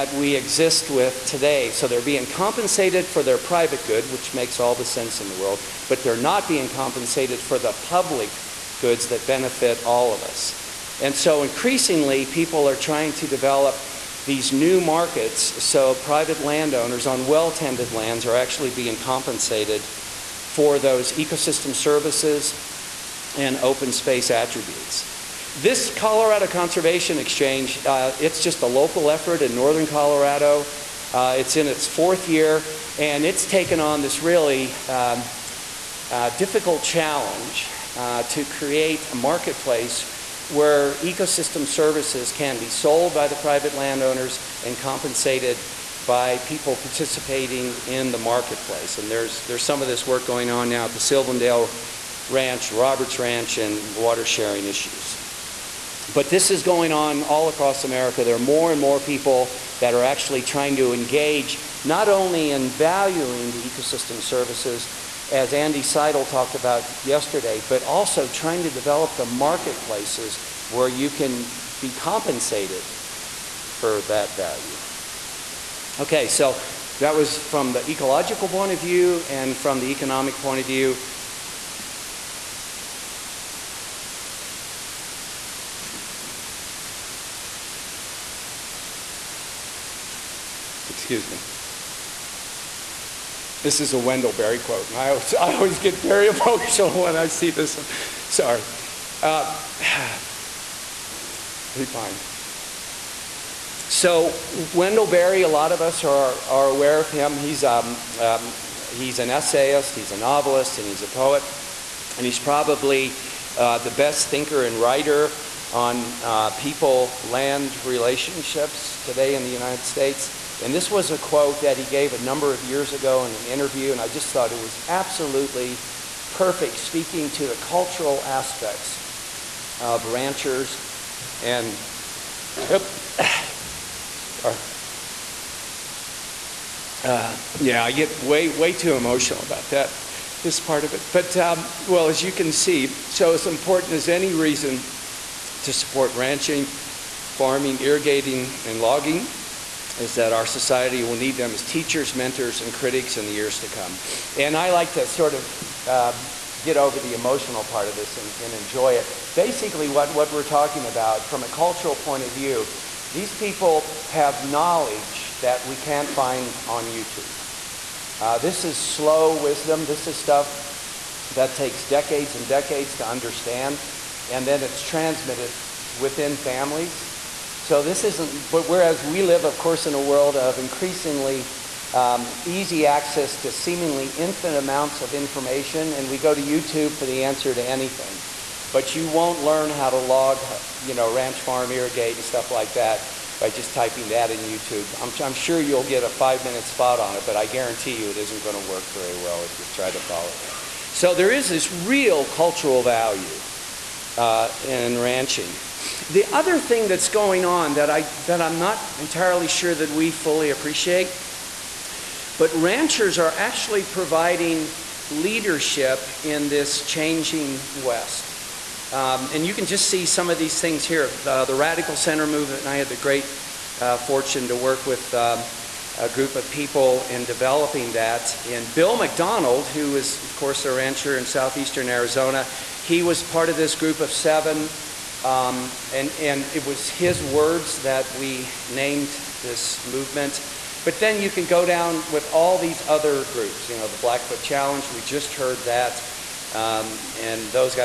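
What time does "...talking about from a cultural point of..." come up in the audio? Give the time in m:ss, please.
2:40.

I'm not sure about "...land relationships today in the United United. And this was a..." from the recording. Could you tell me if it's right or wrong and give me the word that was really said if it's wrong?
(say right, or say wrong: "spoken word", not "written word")
wrong: "States", not "United".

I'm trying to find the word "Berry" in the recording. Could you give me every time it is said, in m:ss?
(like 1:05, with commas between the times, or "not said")
1:34, 1:45.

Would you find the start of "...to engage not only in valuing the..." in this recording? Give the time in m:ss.
1:00.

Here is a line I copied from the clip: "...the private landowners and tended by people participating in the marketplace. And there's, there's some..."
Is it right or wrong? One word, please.
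wrong.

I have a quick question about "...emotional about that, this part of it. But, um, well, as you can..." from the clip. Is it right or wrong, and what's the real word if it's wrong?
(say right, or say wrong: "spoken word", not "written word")
right.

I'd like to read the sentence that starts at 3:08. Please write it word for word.
But you won't learn how to log, you know, ranch farm irrigate and stuff like that by just typing that in YouTube.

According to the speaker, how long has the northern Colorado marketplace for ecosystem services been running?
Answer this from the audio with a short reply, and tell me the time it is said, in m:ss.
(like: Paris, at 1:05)
4 years, at 0:31.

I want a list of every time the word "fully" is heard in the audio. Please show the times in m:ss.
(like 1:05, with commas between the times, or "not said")
3:30.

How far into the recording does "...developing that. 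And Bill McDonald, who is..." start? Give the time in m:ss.
3:47.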